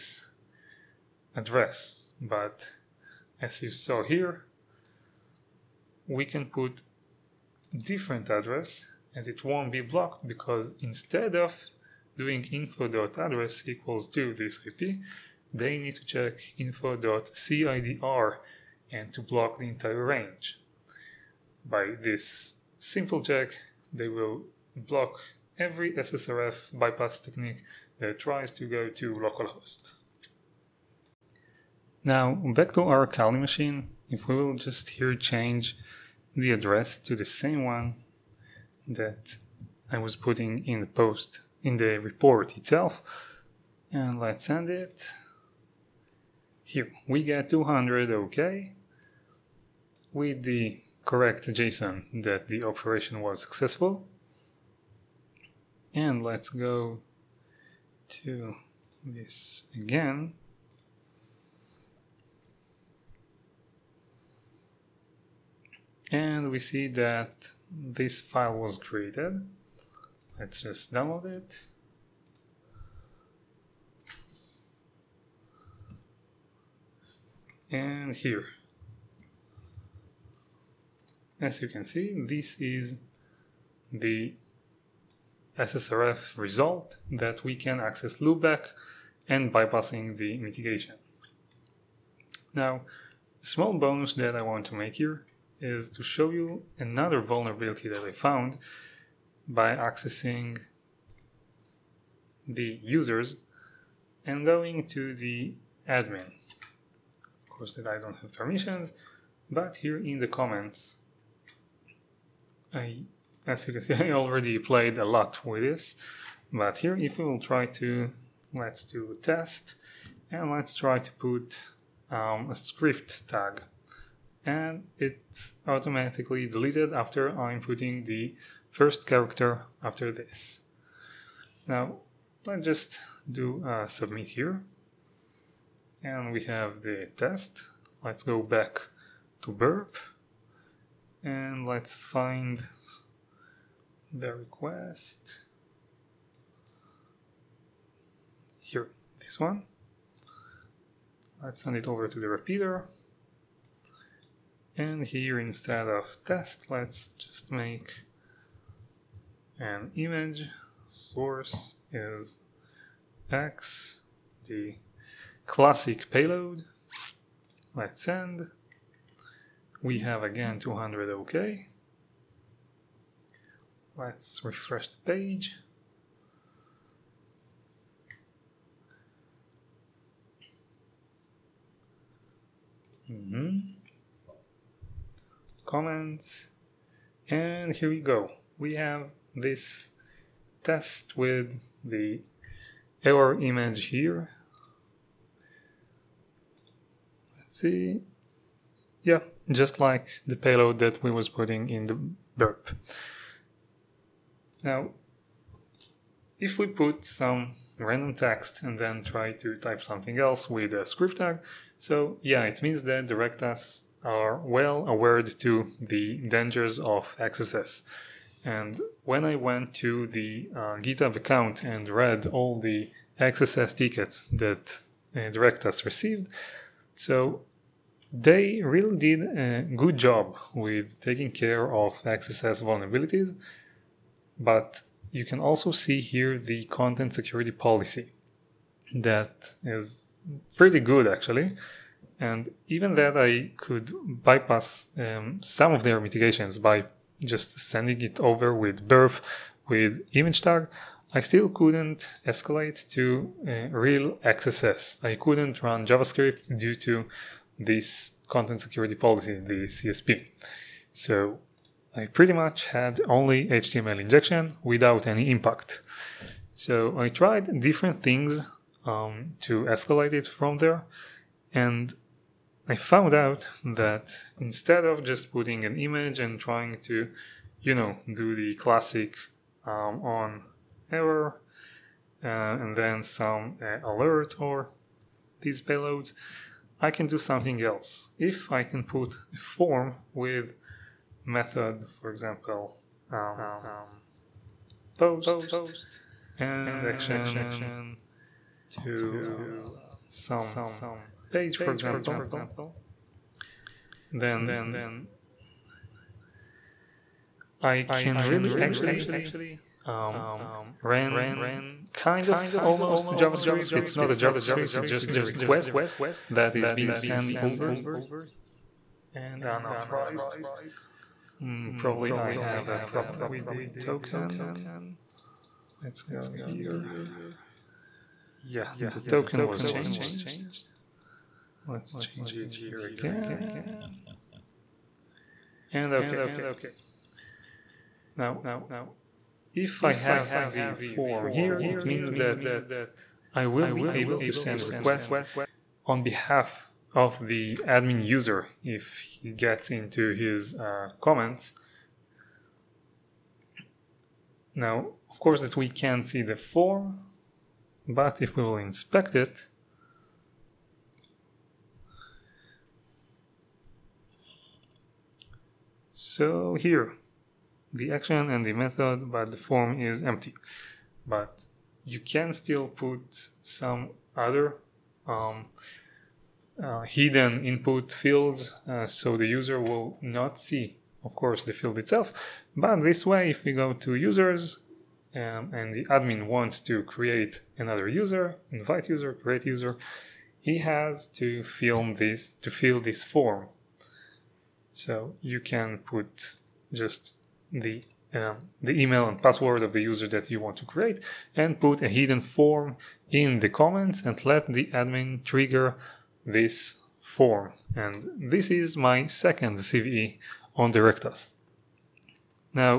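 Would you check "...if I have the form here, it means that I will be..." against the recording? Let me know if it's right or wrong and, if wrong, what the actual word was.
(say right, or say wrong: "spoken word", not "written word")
right.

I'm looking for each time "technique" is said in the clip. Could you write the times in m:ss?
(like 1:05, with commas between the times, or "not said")
0:27.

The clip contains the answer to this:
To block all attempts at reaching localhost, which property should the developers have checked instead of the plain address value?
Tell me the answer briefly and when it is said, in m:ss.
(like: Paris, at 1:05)
info.cidr, at 0:16.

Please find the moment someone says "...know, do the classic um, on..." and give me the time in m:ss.
4:37.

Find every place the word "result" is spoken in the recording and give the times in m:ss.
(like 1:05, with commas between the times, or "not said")
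1:26.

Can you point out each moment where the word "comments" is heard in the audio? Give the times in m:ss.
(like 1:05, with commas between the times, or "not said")
1:50, 3:05, 5:51, 6:43.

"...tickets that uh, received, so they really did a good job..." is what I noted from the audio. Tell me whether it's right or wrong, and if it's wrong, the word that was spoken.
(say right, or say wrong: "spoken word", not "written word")
right.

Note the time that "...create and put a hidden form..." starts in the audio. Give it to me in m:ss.
6:40.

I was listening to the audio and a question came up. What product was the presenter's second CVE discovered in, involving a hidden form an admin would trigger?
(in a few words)
Directus.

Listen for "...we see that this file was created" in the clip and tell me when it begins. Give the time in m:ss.
1:06.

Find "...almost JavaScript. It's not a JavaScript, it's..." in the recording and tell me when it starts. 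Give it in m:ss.
5:12.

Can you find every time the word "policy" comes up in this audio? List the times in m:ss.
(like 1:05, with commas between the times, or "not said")
3:57, 4:18.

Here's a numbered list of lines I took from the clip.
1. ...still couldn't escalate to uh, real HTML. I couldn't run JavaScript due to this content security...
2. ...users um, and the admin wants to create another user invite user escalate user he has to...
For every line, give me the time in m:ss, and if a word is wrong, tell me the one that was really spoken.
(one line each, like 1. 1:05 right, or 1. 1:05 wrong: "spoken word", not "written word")
1. 4:11 wrong: "XSS", not "HTML"
2. 6:23 wrong: "create", not "escalate".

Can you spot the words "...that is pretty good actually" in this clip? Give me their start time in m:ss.
3:58.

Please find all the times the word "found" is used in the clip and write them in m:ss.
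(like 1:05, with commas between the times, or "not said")
1:38, 4:32.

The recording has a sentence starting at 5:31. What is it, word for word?
Let's change it here again and OK.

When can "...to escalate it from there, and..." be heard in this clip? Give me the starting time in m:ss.
4:29.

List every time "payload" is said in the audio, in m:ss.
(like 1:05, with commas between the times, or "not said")
2:46, 3:20, 4:45.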